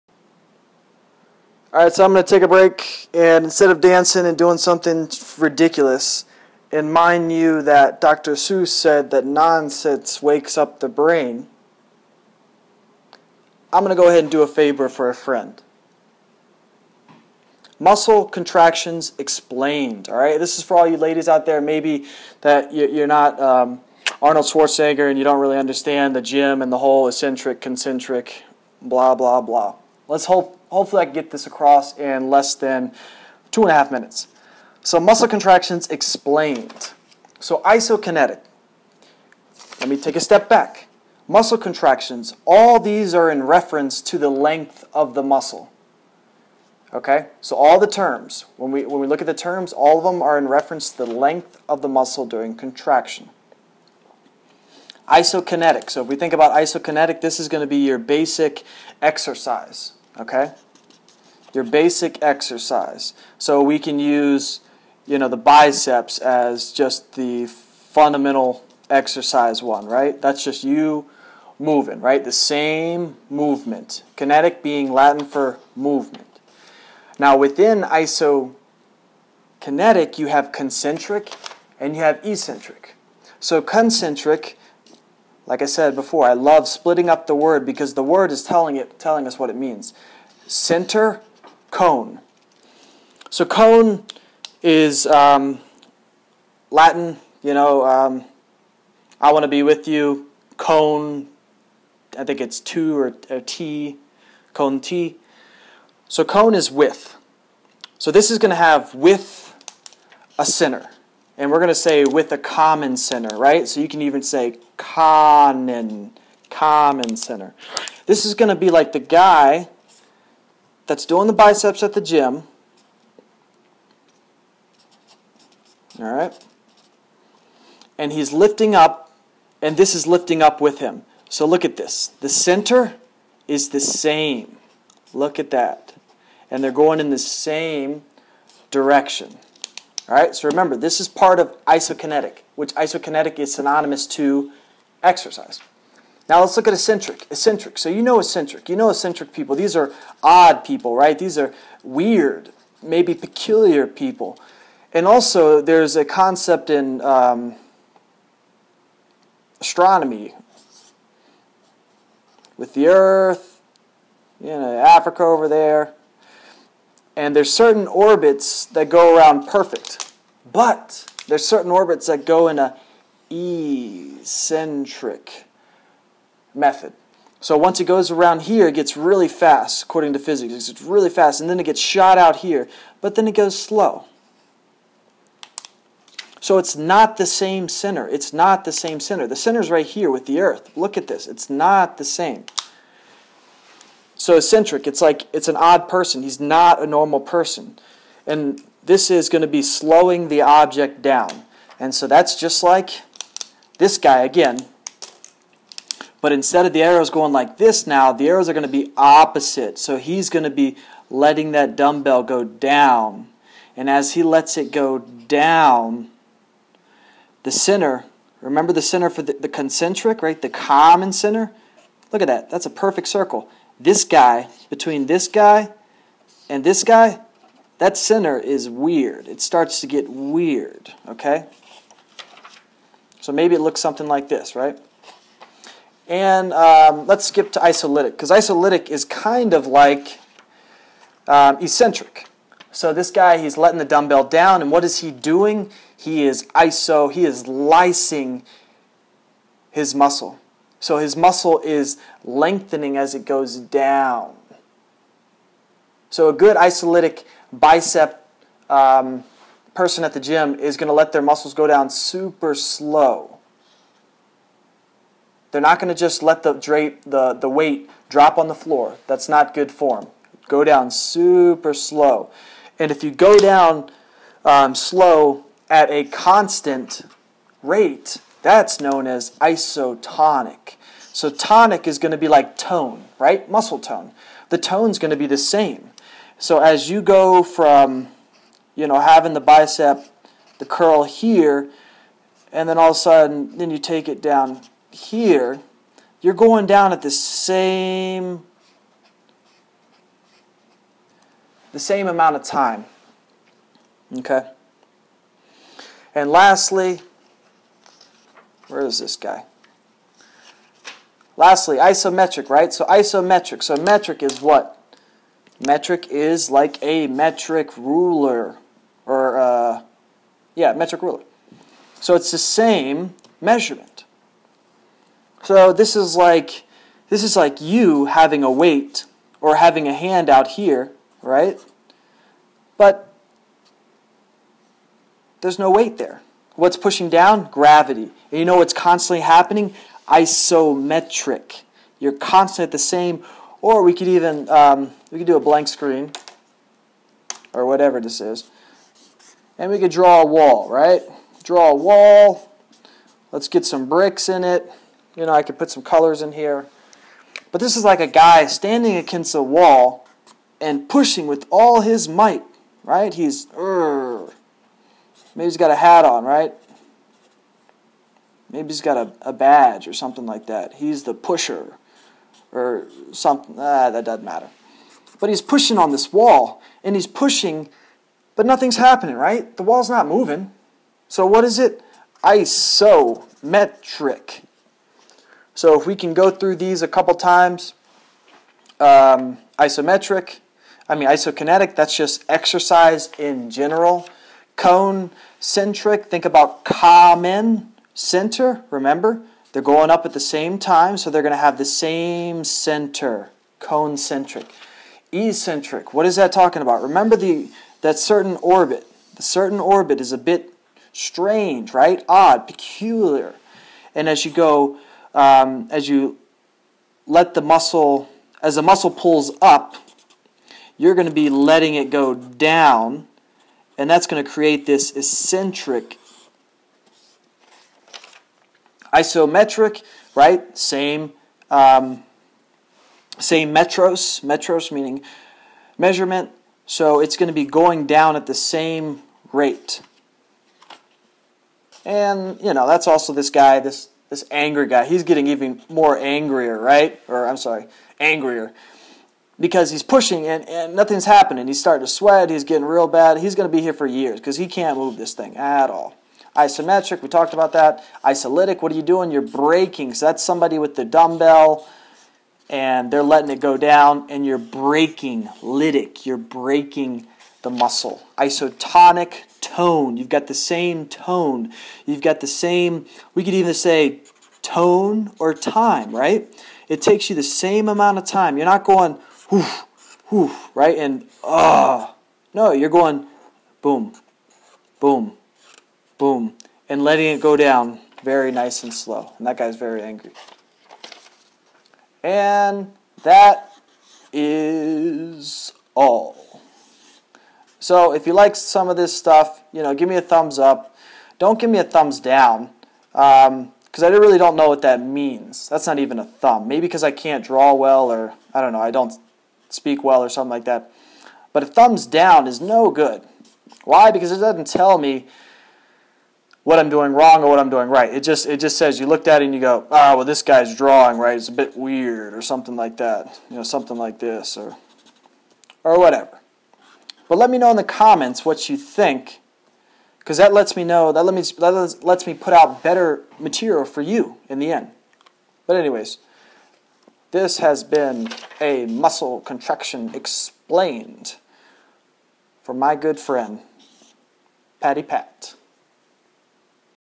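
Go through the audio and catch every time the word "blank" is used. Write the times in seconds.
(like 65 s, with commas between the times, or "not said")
345 s.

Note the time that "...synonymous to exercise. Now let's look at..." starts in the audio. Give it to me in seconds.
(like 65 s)
143 s.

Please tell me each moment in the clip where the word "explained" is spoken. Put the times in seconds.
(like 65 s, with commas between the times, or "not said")
19 s, 35 s, 539 s.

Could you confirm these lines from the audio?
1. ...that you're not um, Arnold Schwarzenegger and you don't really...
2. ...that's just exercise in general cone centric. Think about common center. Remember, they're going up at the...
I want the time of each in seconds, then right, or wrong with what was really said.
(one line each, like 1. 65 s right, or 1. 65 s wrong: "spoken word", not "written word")
1. 22 s right
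2. 391 s right.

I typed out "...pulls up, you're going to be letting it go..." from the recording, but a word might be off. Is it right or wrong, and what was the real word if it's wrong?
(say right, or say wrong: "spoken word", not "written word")
right.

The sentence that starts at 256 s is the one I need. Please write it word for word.
So a good isolytic bicep um, person at the gym is going to let their muscles go down super slow.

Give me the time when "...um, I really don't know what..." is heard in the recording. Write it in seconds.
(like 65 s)
503 s.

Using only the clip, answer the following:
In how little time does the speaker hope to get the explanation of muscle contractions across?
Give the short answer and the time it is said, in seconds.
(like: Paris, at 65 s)
two and a half minutes, at 33 s.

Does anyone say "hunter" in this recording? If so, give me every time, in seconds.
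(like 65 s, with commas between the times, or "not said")
not said.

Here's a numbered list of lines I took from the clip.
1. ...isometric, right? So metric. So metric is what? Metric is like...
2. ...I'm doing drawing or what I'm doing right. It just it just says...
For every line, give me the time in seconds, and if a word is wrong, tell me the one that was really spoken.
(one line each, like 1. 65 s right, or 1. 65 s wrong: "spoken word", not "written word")
1. 311 s wrong: "isometric", not "metric"
2. 516 s wrong: "wrong", not "drawing".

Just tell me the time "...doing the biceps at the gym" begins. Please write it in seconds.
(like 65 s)
121 s.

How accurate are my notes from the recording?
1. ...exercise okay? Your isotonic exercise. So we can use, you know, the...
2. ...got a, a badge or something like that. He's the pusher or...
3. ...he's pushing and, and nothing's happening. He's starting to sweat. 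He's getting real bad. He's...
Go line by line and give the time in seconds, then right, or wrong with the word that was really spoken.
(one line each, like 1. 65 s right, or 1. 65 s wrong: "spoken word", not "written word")
1. 59 s wrong: "basic", not "isotonic"
2. 368 s right
3. 449 s right.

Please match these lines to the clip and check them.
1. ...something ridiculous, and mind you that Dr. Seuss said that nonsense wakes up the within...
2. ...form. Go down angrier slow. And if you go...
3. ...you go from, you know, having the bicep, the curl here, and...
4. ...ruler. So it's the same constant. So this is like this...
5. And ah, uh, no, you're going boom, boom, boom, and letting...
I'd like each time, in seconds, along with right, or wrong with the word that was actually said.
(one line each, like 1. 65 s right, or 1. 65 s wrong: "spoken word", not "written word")
1. 4 s wrong: "brain", not "within"
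2. 269 s wrong: "super", not "angrier"
3. 286 s right
4. 321 s wrong: "measurement", not "constant"
5. 480 s right.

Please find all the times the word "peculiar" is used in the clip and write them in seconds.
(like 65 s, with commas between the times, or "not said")
153 s, 412 s.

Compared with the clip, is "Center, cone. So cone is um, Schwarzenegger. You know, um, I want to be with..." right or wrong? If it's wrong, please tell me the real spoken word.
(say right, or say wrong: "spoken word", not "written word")
wrong: "Latin", not "Schwarzenegger".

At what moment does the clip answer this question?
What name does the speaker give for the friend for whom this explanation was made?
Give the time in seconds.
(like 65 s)
544 s.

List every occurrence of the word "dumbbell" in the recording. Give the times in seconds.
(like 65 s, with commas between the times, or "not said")
211 s, 243 s, 460 s.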